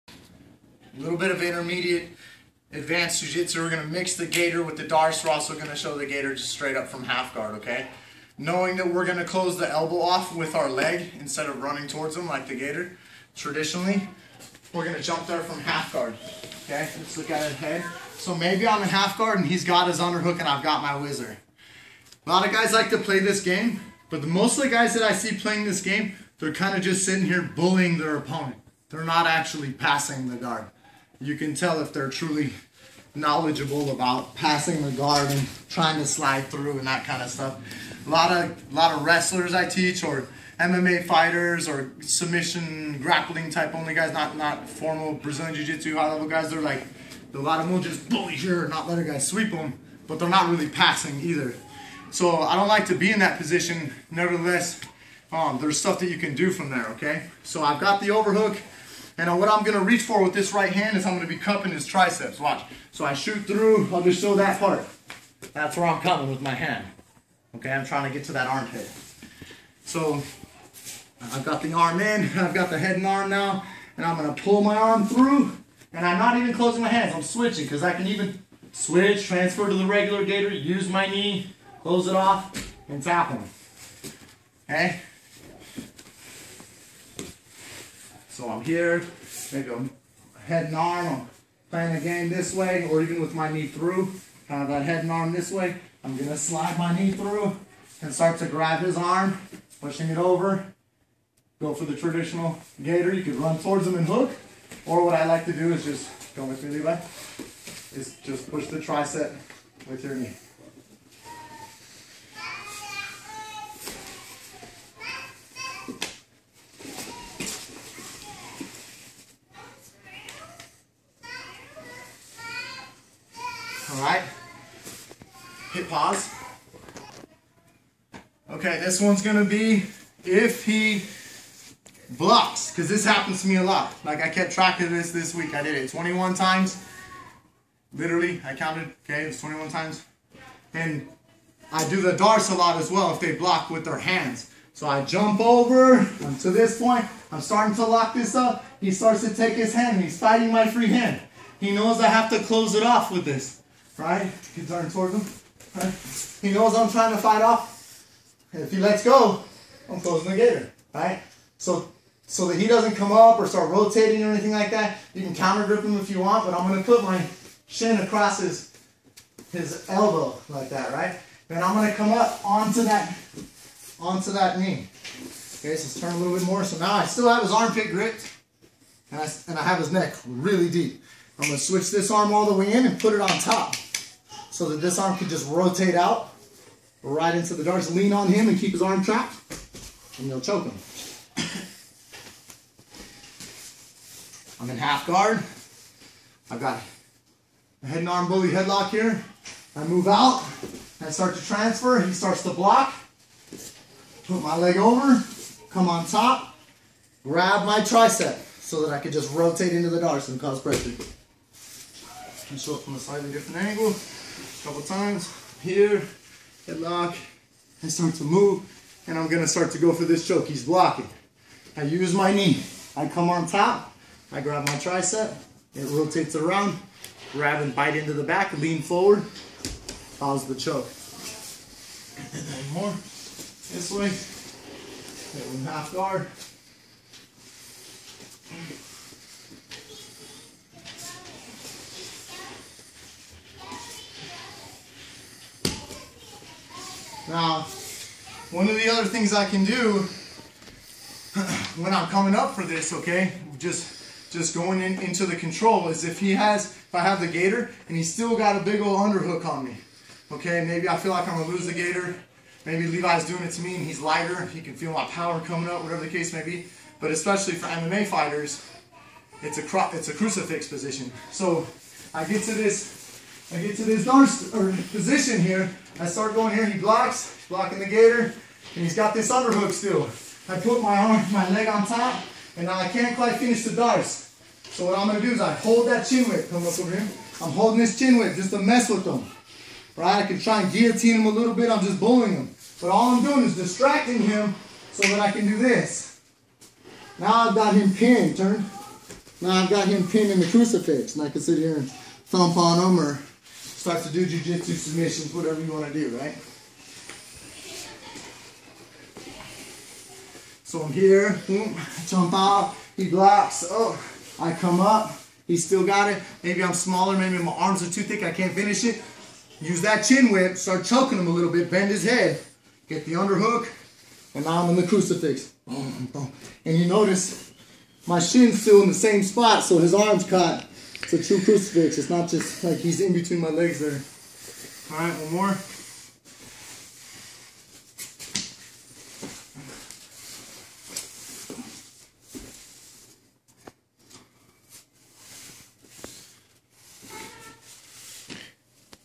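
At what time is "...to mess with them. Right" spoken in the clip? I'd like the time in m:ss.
4:48.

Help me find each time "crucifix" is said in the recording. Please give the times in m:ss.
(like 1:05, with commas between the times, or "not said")
4:30, 5:00, 5:24, 5:31.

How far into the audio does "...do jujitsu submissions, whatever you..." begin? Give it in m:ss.
5:04.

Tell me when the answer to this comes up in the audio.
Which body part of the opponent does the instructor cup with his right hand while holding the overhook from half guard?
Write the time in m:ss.
1:01.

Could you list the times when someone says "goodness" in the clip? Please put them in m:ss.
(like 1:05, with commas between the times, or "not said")
not said.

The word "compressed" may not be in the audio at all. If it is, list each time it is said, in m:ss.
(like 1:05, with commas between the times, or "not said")
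not said.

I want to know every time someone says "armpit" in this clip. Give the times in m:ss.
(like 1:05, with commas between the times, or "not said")
1:08, 2:57.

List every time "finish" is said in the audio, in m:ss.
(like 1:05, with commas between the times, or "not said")
4:43, 5:18.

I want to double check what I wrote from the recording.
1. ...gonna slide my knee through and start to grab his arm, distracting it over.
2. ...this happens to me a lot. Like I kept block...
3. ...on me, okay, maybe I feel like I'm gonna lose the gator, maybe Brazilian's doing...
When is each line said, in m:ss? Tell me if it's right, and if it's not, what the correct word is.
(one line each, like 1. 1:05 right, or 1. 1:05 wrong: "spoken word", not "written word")
1. 1:36 wrong: "pushing", not "distracting"
2. 2:12 wrong: "track", not "block"
3. 4:19 wrong: "Levi", not "Brazilian".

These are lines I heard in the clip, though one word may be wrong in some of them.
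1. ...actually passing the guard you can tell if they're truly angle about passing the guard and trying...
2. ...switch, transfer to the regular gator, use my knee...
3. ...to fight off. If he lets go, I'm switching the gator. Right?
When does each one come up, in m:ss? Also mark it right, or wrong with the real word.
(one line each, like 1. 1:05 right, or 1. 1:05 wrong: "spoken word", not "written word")
1. 0:29 wrong: "knowledgeable", not "angle"
2. 1:18 right
3. 2:37 wrong: "closing", not "switching".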